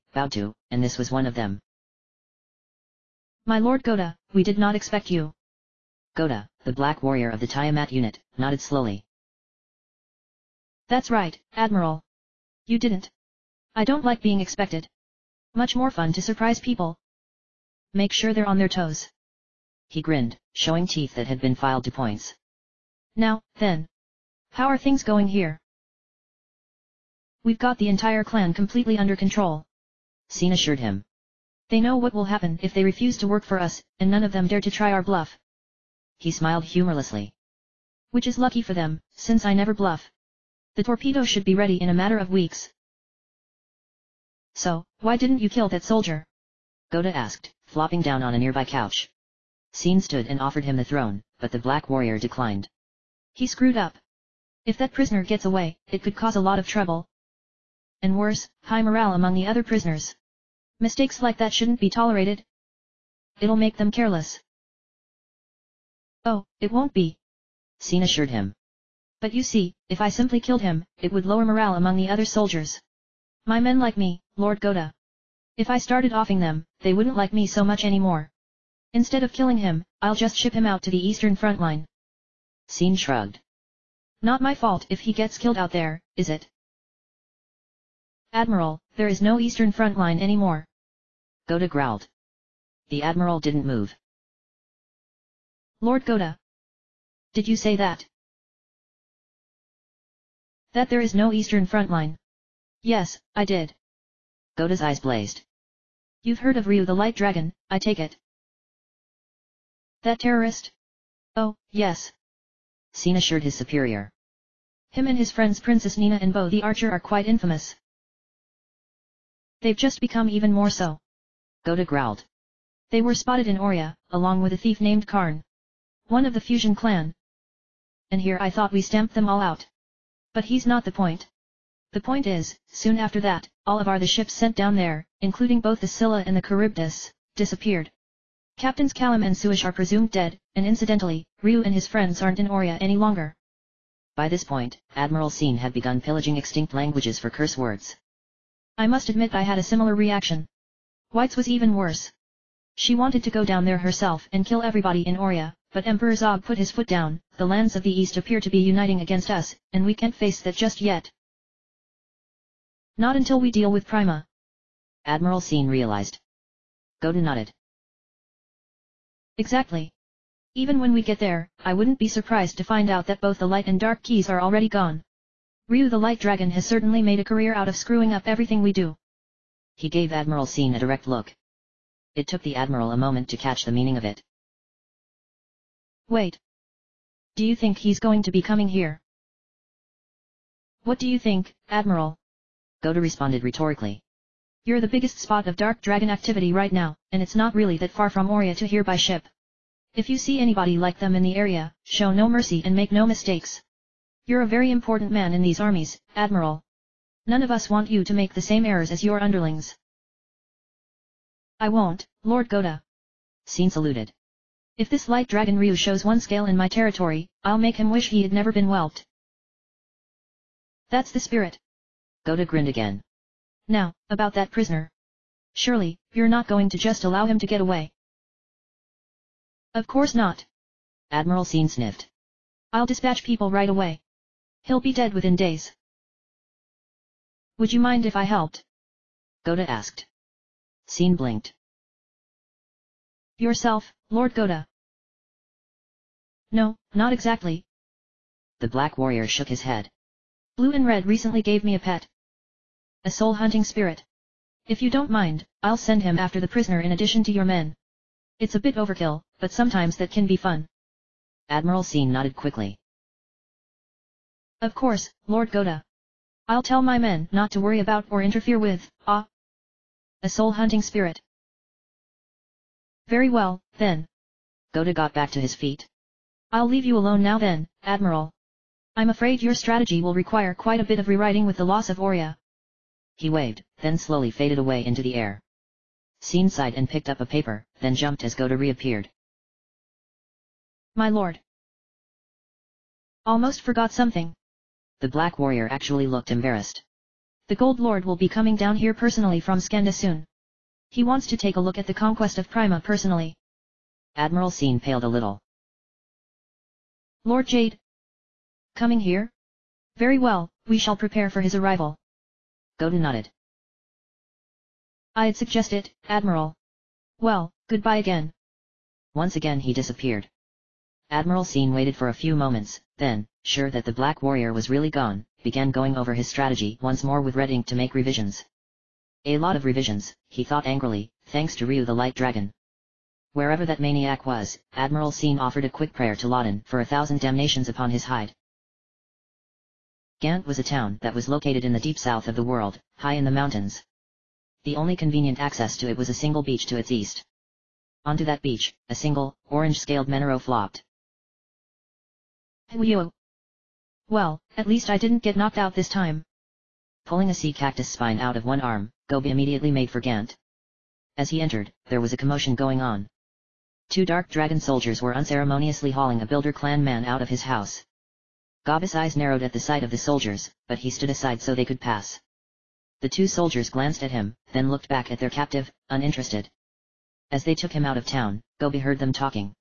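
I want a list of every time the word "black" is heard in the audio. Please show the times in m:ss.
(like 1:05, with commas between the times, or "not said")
0:06, 0:51, 4:08, 4:55, 5:23.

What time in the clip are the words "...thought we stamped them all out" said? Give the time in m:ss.
2:08.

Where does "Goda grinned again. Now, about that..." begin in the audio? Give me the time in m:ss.
3:42.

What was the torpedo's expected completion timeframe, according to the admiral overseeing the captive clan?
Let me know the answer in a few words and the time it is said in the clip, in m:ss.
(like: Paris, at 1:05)
A matter of weeks, at 0:41.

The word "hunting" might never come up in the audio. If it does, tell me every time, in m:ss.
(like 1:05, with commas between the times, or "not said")
4:13, 4:30.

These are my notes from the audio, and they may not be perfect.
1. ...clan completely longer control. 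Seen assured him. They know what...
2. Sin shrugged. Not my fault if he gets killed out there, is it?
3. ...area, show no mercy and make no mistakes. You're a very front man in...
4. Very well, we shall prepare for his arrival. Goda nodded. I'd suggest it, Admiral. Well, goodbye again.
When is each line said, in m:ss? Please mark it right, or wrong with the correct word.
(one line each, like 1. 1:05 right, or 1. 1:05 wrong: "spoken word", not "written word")
1. 0:28 wrong: "under", not "longer"
2. 1:22 right
3. 3:21 wrong: "important", not "front"
4. 5:09 right.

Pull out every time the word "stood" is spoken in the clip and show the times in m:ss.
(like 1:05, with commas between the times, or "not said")
0:50, 6:10.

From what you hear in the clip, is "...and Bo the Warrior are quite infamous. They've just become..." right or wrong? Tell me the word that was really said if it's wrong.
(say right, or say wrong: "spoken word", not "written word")
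wrong: "Archer", not "Warrior".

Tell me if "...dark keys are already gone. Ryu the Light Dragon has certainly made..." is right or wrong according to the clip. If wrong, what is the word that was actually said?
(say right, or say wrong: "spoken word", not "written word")
right.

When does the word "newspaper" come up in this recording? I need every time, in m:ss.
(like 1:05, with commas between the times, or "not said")
not said.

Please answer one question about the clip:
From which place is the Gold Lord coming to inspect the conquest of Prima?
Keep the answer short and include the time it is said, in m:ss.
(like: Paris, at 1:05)
Scande, at 4:59.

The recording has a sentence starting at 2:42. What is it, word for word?
Not until we deal with Prima.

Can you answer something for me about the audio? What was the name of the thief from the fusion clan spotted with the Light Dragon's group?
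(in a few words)
Karn.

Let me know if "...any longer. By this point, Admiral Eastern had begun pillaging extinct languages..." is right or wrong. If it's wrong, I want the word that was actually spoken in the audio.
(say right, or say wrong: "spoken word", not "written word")
wrong: "Scene", not "Eastern".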